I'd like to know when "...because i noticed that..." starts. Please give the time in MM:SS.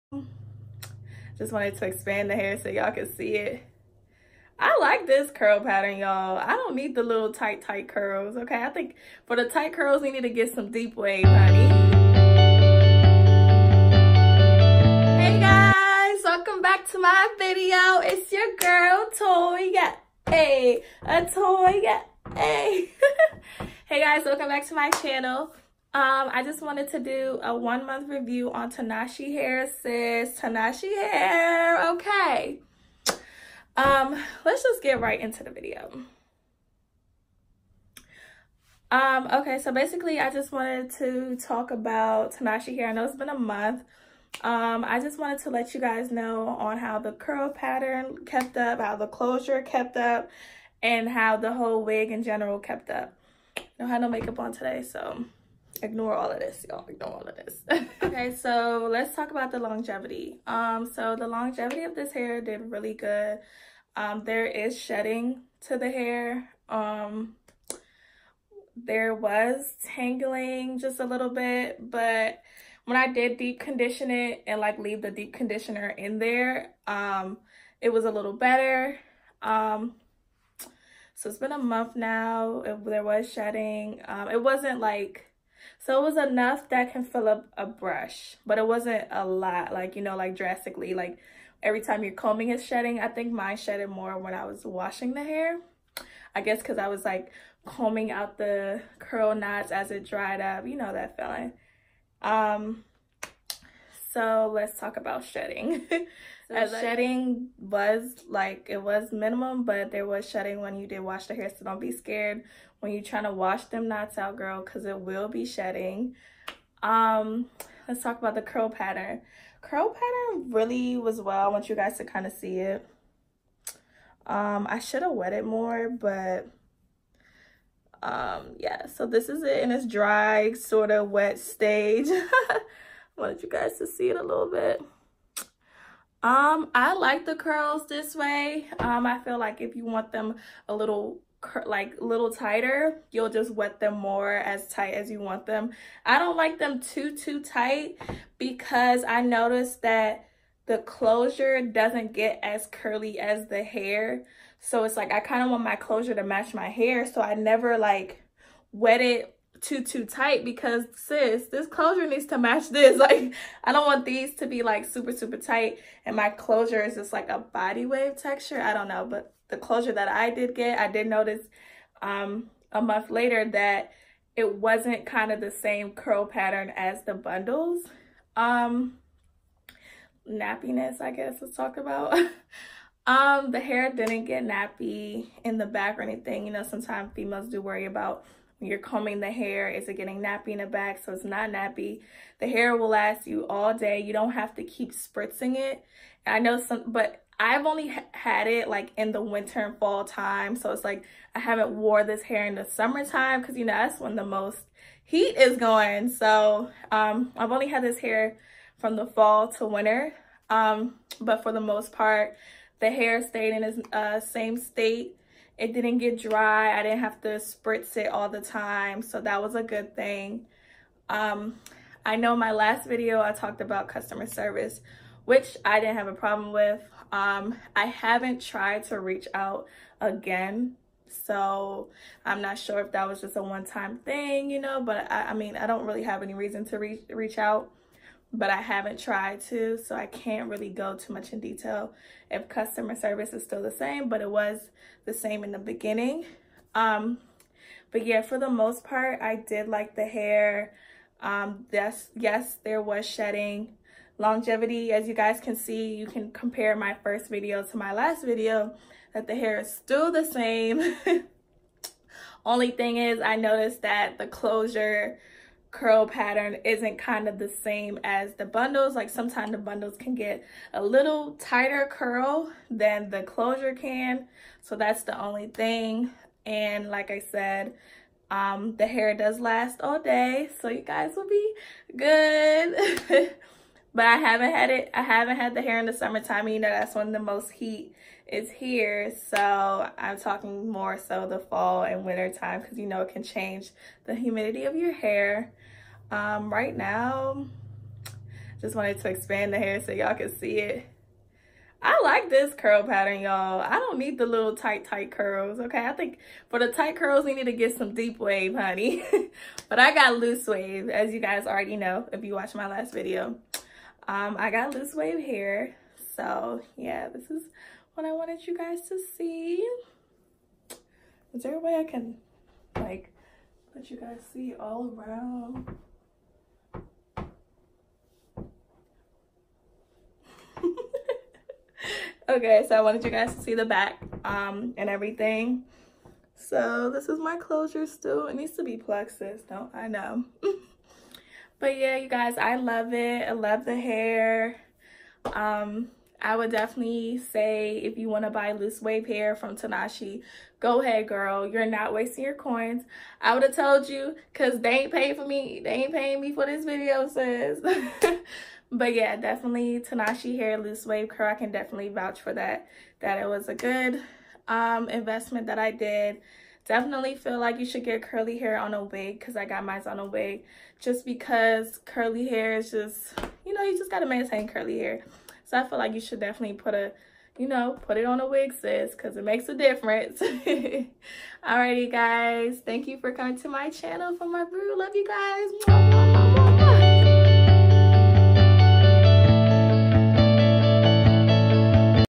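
02:28.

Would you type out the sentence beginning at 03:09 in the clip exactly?
Is it getting nappy in the back?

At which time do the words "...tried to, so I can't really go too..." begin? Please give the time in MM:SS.
03:58.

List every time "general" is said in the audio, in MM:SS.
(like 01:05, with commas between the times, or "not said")
00:52.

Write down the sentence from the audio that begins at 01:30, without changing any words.
Like every time you're combing is shedding.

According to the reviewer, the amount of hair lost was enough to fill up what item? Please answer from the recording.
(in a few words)
a brush.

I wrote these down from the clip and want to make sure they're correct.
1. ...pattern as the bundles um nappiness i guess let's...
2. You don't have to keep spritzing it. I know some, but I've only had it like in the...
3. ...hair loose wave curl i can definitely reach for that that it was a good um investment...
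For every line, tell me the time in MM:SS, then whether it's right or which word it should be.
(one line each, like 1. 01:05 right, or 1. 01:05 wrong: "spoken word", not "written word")
1. 02:56 right
2. 03:13 right
3. 06:00 wrong: "vouch", not "reach".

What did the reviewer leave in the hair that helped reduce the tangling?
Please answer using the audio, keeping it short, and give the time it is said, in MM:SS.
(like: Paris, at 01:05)
deep conditioner, at 01:15.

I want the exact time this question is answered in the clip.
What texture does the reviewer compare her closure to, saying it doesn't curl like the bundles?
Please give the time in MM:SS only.
02:47.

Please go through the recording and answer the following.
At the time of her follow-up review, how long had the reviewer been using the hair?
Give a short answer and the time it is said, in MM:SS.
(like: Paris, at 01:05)
one month, at 00:27.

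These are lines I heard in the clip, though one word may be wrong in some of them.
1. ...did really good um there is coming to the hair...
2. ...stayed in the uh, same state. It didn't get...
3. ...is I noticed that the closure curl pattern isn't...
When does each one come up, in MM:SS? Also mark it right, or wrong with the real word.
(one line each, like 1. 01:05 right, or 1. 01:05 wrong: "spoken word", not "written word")
1. 01:02 wrong: "shedding", not "coming"
2. 03:33 right
3. 04:22 right.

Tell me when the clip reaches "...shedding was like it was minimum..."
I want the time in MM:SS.
01:46.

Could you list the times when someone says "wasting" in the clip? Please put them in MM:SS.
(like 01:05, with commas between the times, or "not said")
05:51.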